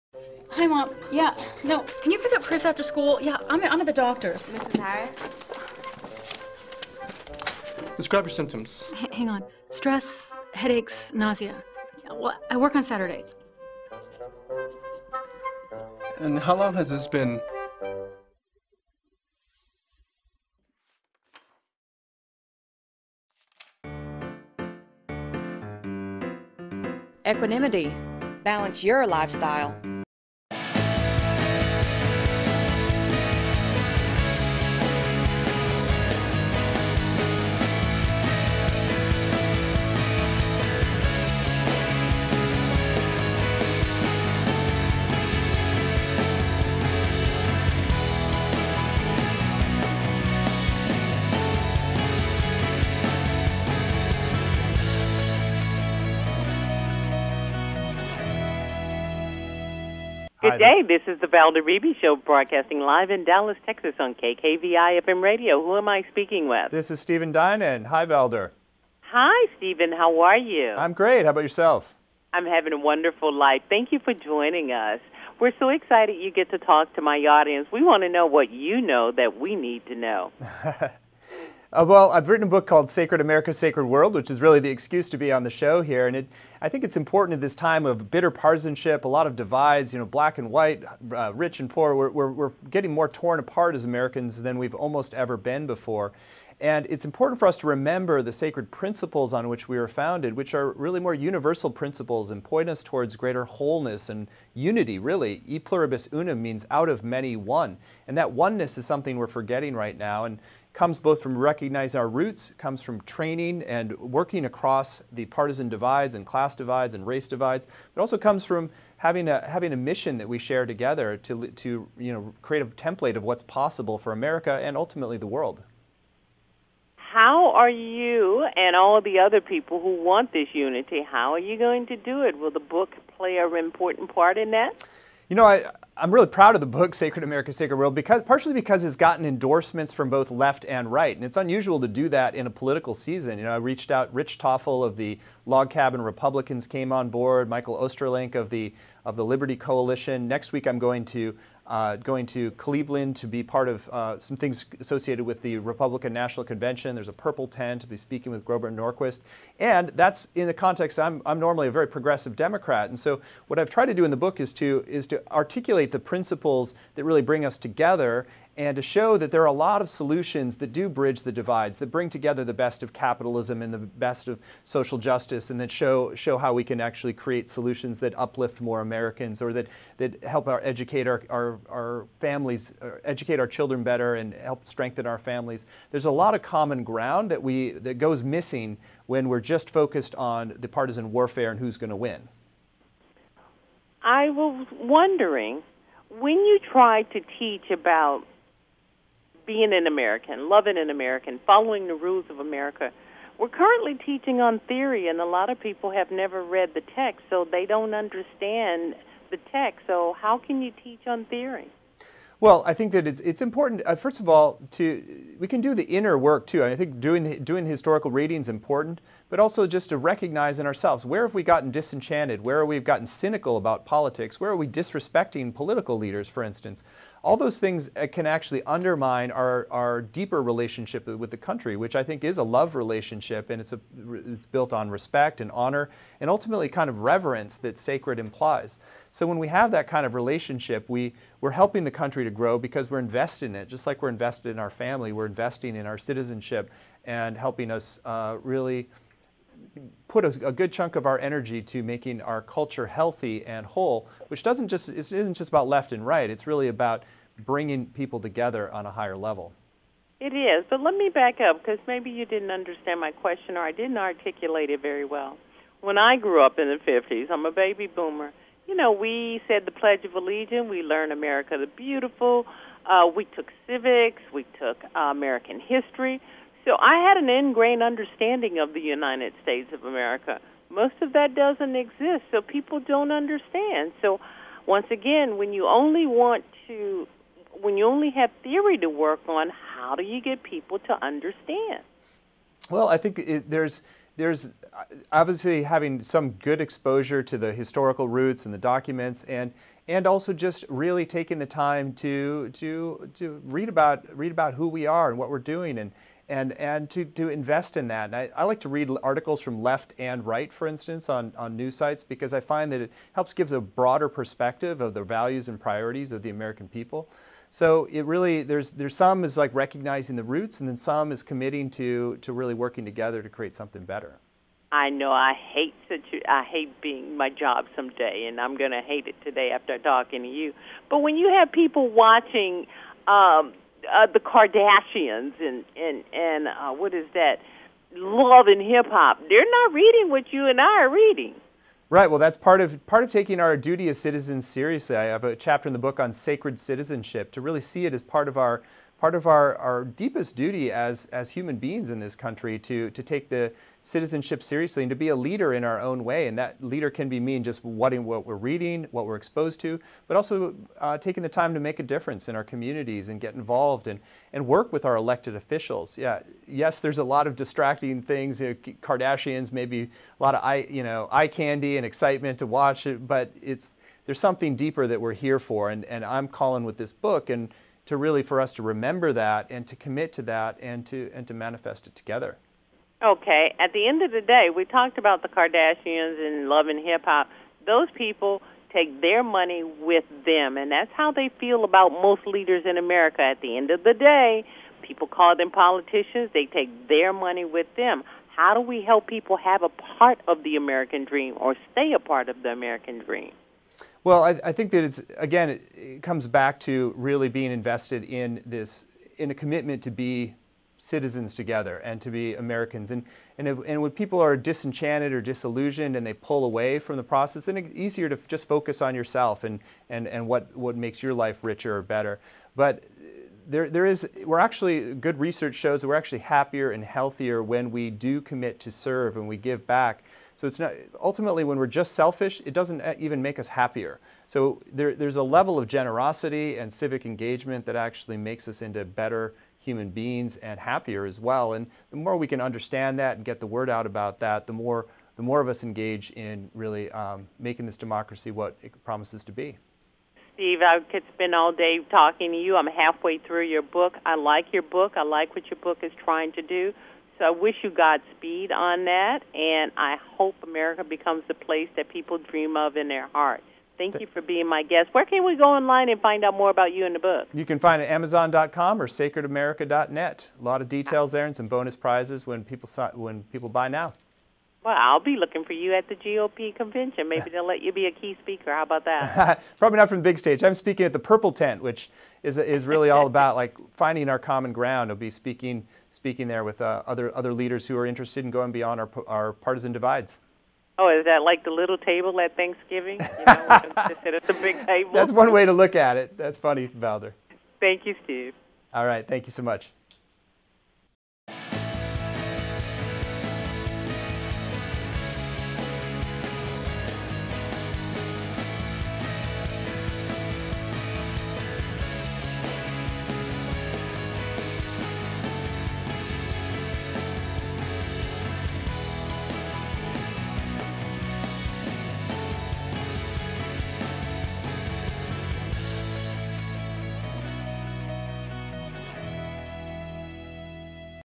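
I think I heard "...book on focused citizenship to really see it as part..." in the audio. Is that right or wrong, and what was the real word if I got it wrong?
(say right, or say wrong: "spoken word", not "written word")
wrong: "sacred", not "focused".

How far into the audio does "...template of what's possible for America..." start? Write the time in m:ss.
2:02.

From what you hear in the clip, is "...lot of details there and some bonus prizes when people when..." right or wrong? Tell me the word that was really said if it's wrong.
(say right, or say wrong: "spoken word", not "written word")
right.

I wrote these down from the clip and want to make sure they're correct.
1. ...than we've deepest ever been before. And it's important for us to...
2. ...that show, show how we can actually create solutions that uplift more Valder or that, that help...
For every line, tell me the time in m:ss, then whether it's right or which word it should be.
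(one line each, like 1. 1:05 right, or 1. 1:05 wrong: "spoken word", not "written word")
1. 1:34 wrong: "almost", not "deepest"
2. 2:55 wrong: "Americans", not "Valder".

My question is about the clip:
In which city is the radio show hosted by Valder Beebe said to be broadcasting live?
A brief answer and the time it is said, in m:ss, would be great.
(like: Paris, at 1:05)
Dallas, Texas, at 1:03.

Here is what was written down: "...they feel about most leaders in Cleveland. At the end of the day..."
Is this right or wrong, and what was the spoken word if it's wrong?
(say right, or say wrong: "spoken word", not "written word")
wrong: "America", not "Cleveland".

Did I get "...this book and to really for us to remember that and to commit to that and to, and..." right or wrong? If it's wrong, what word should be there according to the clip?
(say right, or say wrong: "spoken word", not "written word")
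right.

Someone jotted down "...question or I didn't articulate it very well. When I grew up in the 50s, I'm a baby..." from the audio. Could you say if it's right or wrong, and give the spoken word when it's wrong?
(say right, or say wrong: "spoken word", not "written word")
right.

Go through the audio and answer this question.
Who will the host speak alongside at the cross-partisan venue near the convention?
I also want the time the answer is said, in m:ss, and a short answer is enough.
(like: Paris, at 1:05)
Grover Norquist, at 2:38.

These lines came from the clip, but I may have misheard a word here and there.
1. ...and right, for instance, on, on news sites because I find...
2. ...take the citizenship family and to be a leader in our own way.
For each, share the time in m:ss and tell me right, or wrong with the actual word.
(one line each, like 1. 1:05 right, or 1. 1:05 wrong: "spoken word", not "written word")
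1. 5:09 right
2. 5:53 wrong: "seriously", not "family".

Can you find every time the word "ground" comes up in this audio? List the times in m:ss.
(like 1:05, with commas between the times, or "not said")
3:06, 8:04.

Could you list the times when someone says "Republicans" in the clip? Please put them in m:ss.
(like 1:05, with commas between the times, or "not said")
2:26, 2:35.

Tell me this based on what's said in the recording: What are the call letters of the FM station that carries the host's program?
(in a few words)
KKVI.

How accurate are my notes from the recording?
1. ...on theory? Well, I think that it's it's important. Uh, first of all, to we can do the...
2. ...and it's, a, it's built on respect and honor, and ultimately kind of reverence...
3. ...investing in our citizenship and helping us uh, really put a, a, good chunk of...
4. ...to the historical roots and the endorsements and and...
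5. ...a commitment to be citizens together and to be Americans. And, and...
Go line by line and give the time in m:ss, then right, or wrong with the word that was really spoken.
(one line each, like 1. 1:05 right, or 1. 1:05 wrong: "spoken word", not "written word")
1. 3:31 right
2. 3:53 right
3. 4:05 right
4. 4:57 wrong: "documents", not "endorsements"
5. 6:49 right.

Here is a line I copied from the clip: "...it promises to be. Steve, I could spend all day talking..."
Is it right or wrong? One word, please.
right.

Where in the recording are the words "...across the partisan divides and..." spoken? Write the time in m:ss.
1:54.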